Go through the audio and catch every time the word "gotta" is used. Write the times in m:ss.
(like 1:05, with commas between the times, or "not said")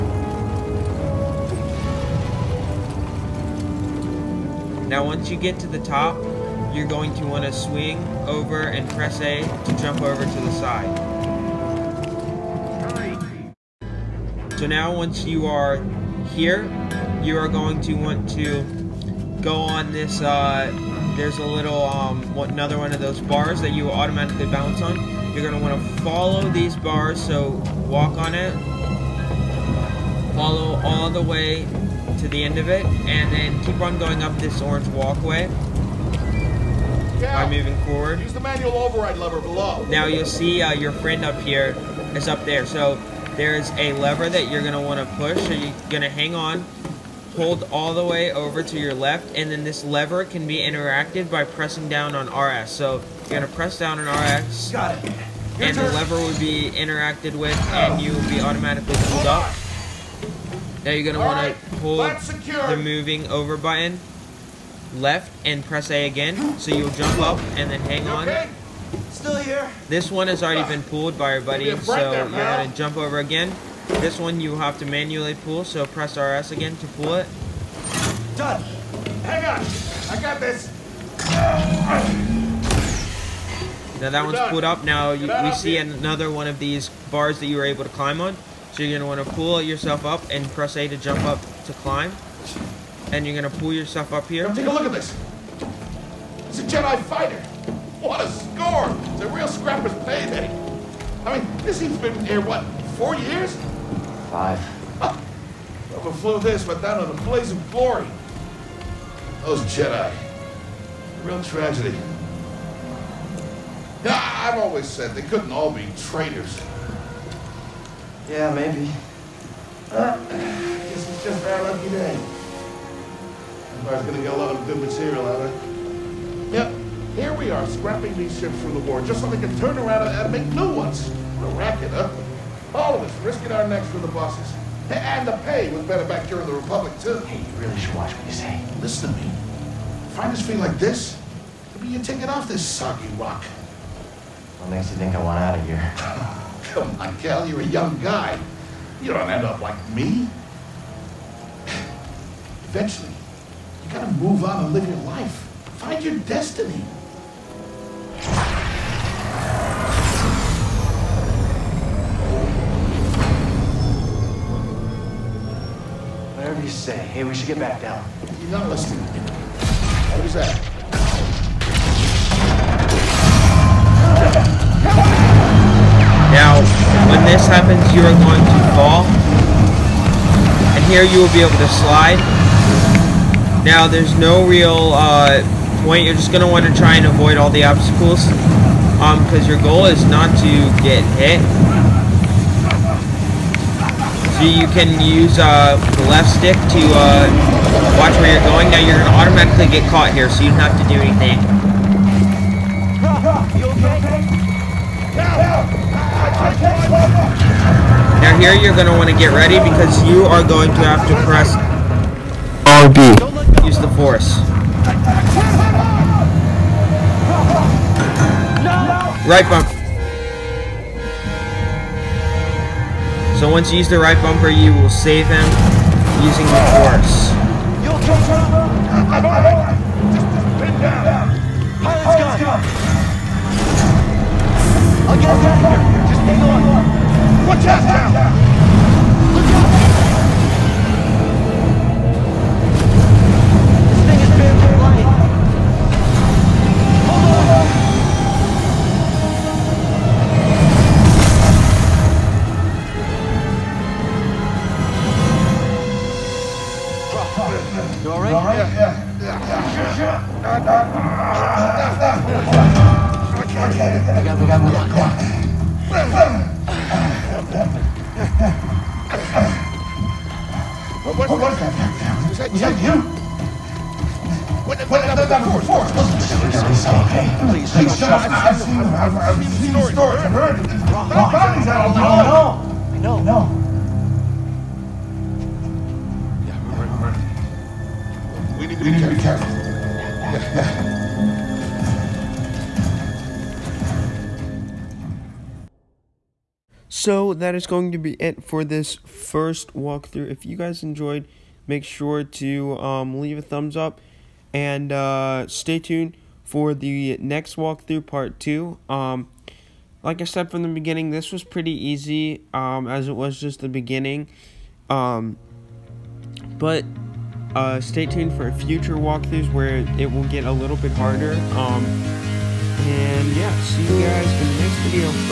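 1:12, 2:33.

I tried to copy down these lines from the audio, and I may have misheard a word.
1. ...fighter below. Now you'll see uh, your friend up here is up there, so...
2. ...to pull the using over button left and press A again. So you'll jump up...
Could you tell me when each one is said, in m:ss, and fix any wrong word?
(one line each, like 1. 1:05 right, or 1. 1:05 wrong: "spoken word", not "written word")
1. 0:39 wrong: "lever", not "fighter"
2. 1:01 wrong: "moving", not "using".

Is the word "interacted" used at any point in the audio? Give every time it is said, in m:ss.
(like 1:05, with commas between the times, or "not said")
0:50, 0:56.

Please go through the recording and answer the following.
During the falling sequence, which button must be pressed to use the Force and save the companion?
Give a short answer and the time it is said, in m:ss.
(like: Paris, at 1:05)
RB, at 3:32.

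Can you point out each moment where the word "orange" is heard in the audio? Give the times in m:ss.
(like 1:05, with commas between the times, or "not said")
0:34.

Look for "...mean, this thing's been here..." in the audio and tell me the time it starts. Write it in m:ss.
1:41.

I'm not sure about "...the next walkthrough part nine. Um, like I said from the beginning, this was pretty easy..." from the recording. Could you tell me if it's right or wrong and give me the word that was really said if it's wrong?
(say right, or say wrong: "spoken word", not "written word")
wrong: "two", not "nine".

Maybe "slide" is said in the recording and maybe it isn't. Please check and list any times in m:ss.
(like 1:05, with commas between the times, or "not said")
3:01.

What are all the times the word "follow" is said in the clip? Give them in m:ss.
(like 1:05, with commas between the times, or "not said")
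0:26, 0:30.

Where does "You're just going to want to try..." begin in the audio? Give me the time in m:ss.
3:06.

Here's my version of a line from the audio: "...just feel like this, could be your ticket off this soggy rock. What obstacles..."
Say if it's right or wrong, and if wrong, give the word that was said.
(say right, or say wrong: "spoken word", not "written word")
wrong: "makes", not "obstacles".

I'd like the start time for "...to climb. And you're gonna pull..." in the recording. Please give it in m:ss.
1:31.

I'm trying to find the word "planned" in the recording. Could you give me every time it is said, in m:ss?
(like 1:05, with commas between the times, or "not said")
not said.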